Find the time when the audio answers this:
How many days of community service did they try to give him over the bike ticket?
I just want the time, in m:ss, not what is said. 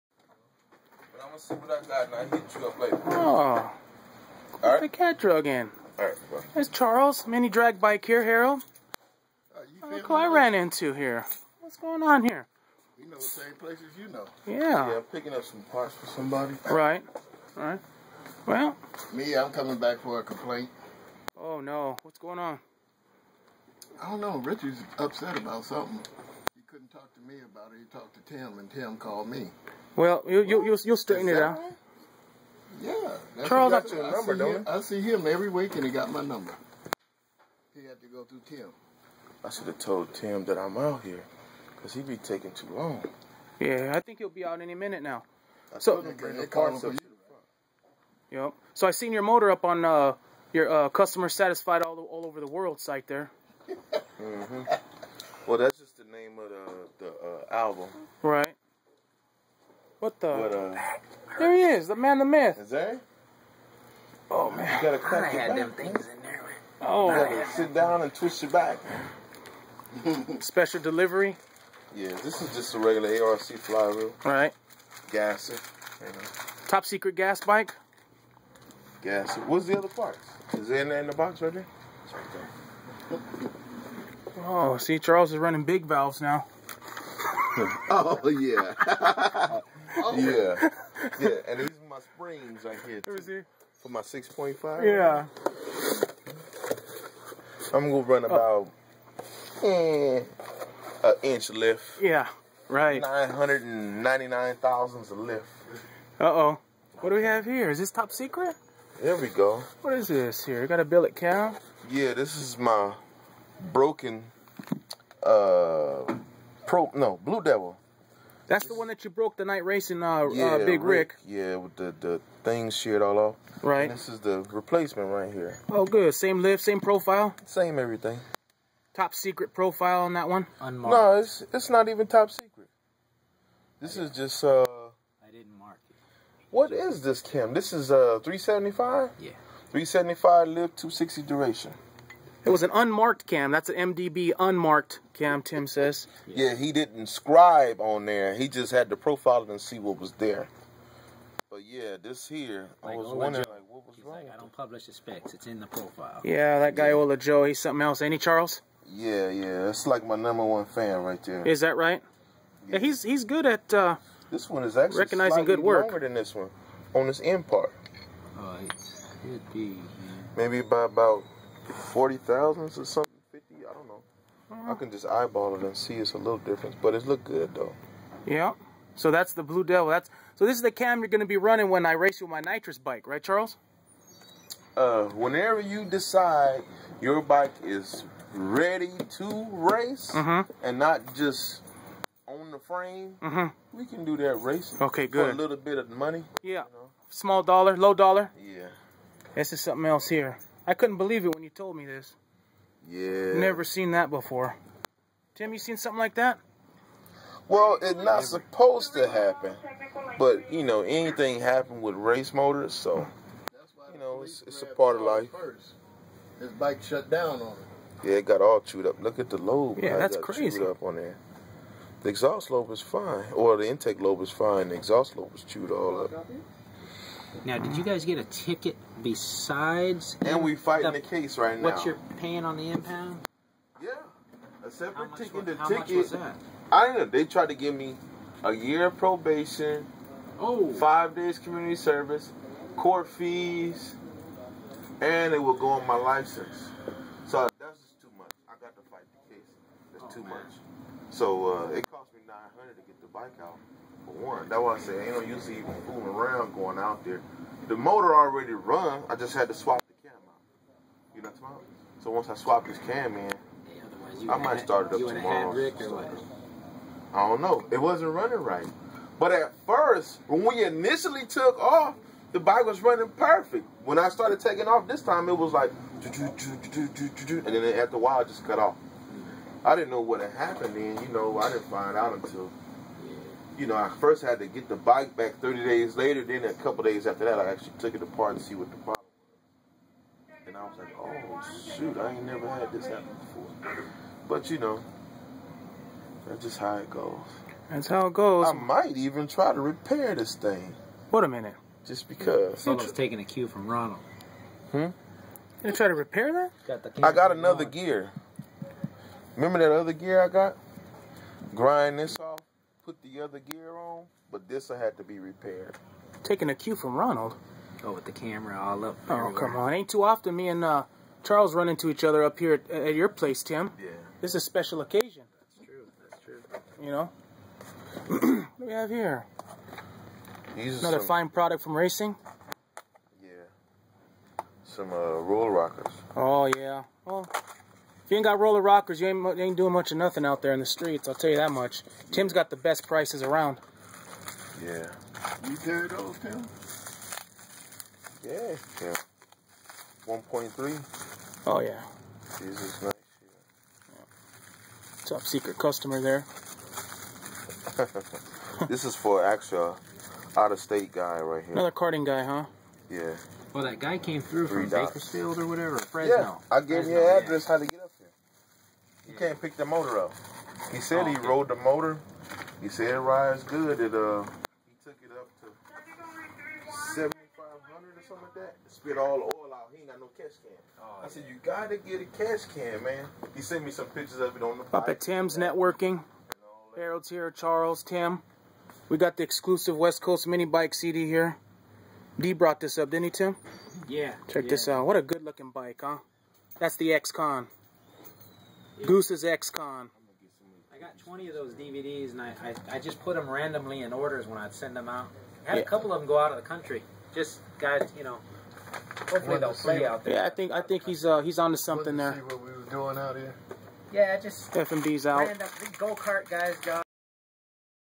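4:00.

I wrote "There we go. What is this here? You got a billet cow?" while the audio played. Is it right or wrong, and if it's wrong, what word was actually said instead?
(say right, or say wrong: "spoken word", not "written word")
right.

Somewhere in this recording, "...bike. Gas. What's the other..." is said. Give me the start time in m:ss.
1:17.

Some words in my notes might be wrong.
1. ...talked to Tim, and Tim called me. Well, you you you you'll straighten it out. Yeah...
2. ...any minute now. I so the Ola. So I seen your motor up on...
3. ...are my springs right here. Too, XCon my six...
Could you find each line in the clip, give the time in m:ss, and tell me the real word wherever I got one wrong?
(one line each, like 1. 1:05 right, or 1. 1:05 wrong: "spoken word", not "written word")
1. 0:27 right
2. 0:44 wrong: "Yep", not "Ola"
3. 1:31 wrong: "For", not "XCon".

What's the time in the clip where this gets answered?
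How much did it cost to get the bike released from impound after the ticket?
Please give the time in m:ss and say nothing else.
4:12.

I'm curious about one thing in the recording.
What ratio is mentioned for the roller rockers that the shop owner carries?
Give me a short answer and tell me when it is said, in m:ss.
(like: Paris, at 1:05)
1.3, at 5:50.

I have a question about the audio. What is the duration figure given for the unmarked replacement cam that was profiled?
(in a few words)
260.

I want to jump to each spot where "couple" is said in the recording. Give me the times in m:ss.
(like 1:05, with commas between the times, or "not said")
4:46, 6:45.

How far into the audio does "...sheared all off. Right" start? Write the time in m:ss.
2:02.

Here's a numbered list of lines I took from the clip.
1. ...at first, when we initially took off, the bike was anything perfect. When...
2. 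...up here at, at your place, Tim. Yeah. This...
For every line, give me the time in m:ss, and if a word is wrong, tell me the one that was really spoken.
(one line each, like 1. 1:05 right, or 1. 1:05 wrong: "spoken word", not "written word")
1. 4:29 wrong: "running", not "anything"
2. 5:22 right.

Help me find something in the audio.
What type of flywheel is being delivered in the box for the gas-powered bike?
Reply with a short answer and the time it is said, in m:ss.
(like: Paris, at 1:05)
ARC flywheel, at 1:13.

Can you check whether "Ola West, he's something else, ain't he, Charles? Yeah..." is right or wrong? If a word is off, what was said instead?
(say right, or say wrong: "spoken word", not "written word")
wrong: "Joe", not "West".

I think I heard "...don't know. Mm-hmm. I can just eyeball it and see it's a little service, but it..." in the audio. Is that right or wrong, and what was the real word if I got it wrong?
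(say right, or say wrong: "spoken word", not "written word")
wrong: "difference", not "service".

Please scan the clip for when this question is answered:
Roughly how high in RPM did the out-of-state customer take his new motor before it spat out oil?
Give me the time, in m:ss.
6:16.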